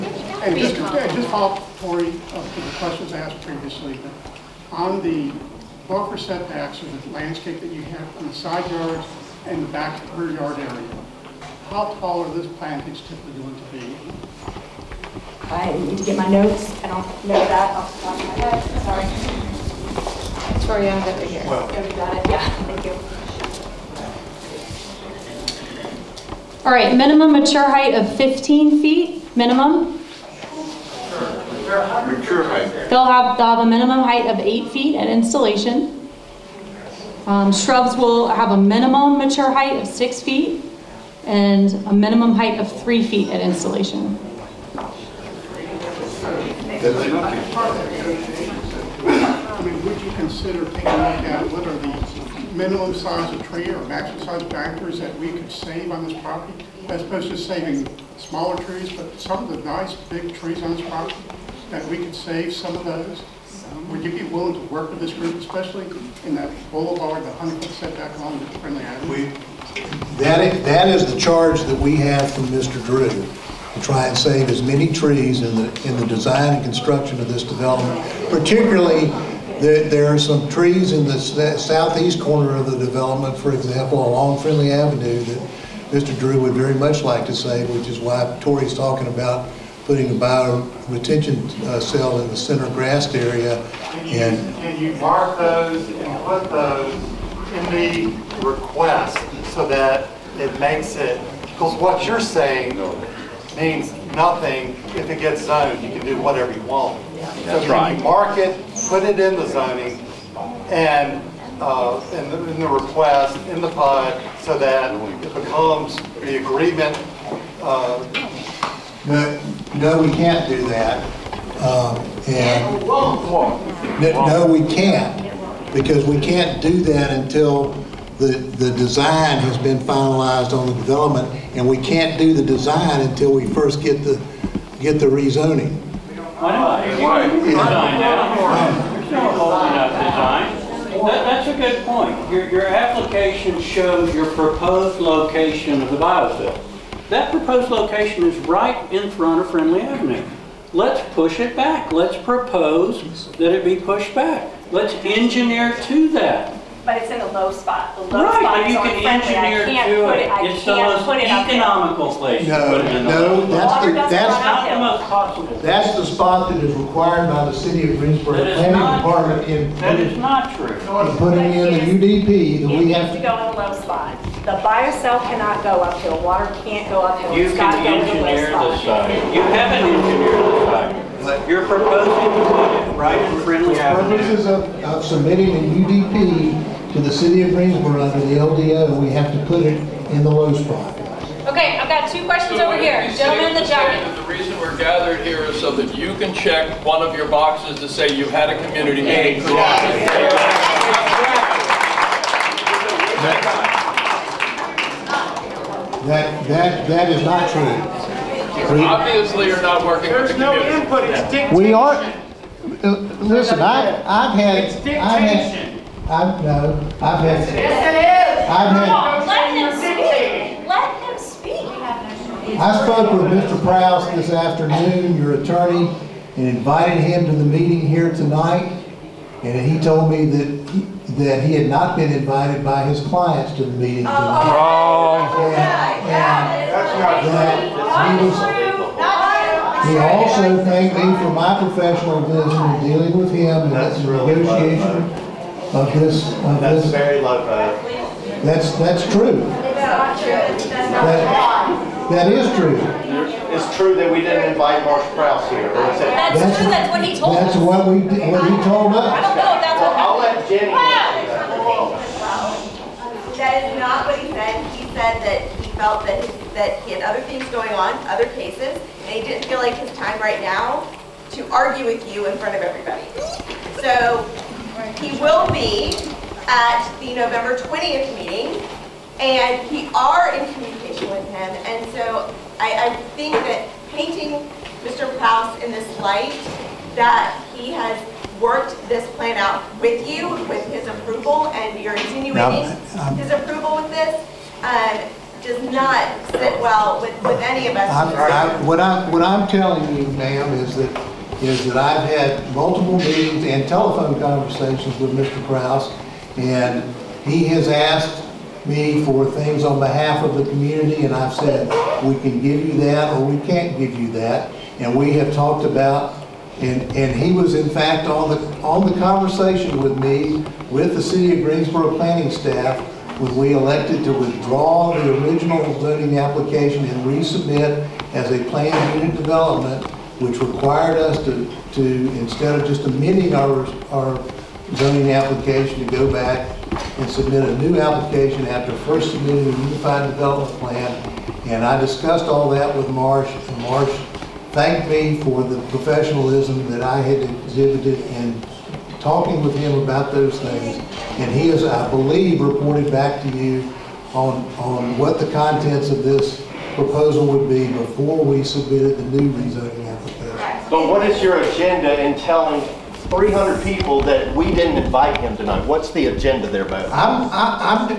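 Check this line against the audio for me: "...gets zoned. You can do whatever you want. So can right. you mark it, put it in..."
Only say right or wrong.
right.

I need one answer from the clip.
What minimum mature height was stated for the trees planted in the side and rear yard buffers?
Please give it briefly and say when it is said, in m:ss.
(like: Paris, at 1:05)
15 feet, at 0:28.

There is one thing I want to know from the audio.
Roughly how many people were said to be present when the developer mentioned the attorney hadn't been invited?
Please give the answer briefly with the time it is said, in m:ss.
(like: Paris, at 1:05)
300, at 6:03.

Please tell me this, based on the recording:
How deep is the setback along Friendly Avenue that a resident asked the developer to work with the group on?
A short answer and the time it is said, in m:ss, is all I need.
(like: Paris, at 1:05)
100 feet, at 1:07.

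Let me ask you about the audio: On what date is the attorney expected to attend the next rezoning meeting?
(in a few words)
November 20th.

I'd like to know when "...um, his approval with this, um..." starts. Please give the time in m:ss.
4:52.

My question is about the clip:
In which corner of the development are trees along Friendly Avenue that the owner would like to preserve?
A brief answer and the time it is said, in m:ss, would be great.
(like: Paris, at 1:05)
southeast corner, at 1:21.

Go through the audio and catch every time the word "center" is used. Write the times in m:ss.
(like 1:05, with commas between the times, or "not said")
1:32.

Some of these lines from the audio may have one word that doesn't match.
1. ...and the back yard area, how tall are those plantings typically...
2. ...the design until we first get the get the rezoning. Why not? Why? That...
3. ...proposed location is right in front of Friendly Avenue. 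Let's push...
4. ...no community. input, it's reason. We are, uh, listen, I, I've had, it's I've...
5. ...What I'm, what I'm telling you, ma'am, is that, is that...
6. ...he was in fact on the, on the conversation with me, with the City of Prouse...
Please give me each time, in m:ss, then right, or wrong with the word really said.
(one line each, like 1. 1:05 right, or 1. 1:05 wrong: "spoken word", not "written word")
1. 0:09 right
2. 2:12 right
3. 2:27 right
4. 3:30 wrong: "dictation", not "reason"
5. 4:58 right
6. 5:17 wrong: "Greensboro", not "Prouse".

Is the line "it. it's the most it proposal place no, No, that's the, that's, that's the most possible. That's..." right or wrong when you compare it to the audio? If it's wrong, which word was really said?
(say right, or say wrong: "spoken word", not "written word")
wrong: "economical", not "proposal".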